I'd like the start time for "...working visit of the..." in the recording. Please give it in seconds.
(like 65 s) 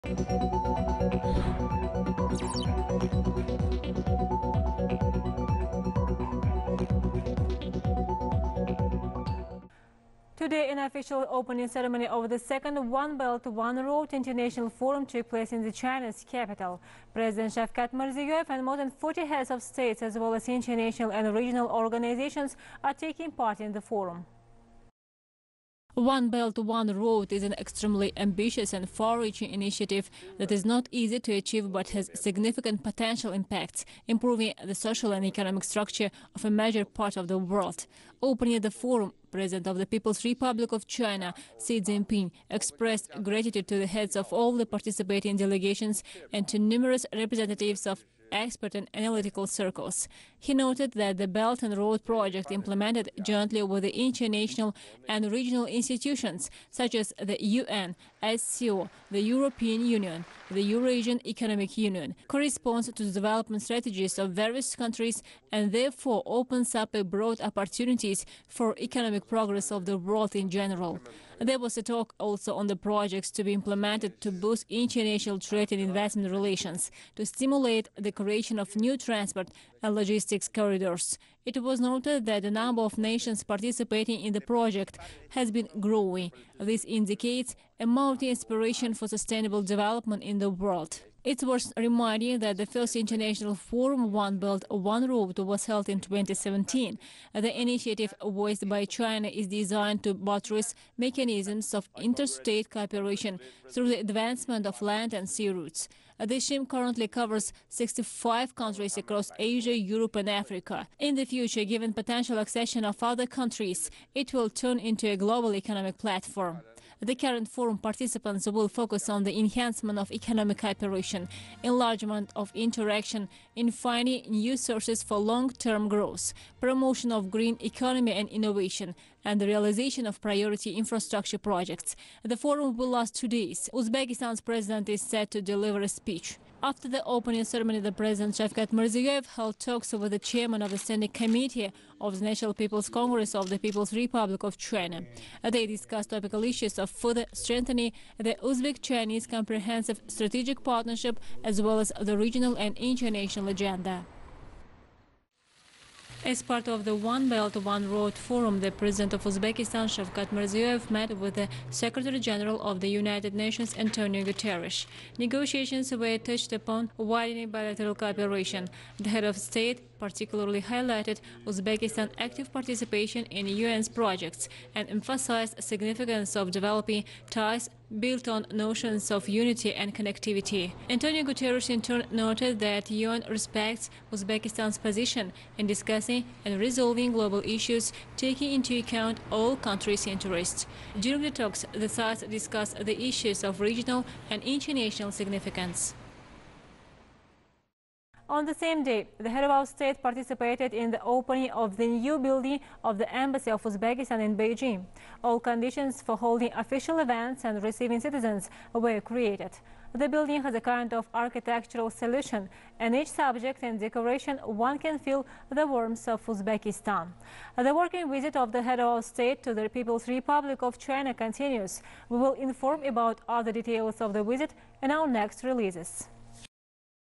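217 s.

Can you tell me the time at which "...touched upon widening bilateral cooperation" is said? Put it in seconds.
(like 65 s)
166 s.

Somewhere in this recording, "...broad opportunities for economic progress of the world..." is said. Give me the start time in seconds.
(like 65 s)
67 s.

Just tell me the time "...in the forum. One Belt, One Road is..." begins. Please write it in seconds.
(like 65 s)
23 s.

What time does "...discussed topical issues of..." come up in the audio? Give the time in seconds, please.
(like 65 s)
145 s.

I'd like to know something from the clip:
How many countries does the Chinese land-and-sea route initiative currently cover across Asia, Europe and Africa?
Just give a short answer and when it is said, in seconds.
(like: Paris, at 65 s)
65, at 107 s.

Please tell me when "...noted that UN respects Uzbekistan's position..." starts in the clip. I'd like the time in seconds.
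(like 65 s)
182 s.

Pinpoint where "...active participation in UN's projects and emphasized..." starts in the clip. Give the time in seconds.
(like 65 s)
172 s.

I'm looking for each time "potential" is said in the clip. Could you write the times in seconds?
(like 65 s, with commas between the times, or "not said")
32 s, 111 s.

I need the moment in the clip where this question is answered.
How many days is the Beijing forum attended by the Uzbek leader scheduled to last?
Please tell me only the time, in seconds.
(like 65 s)
133 s.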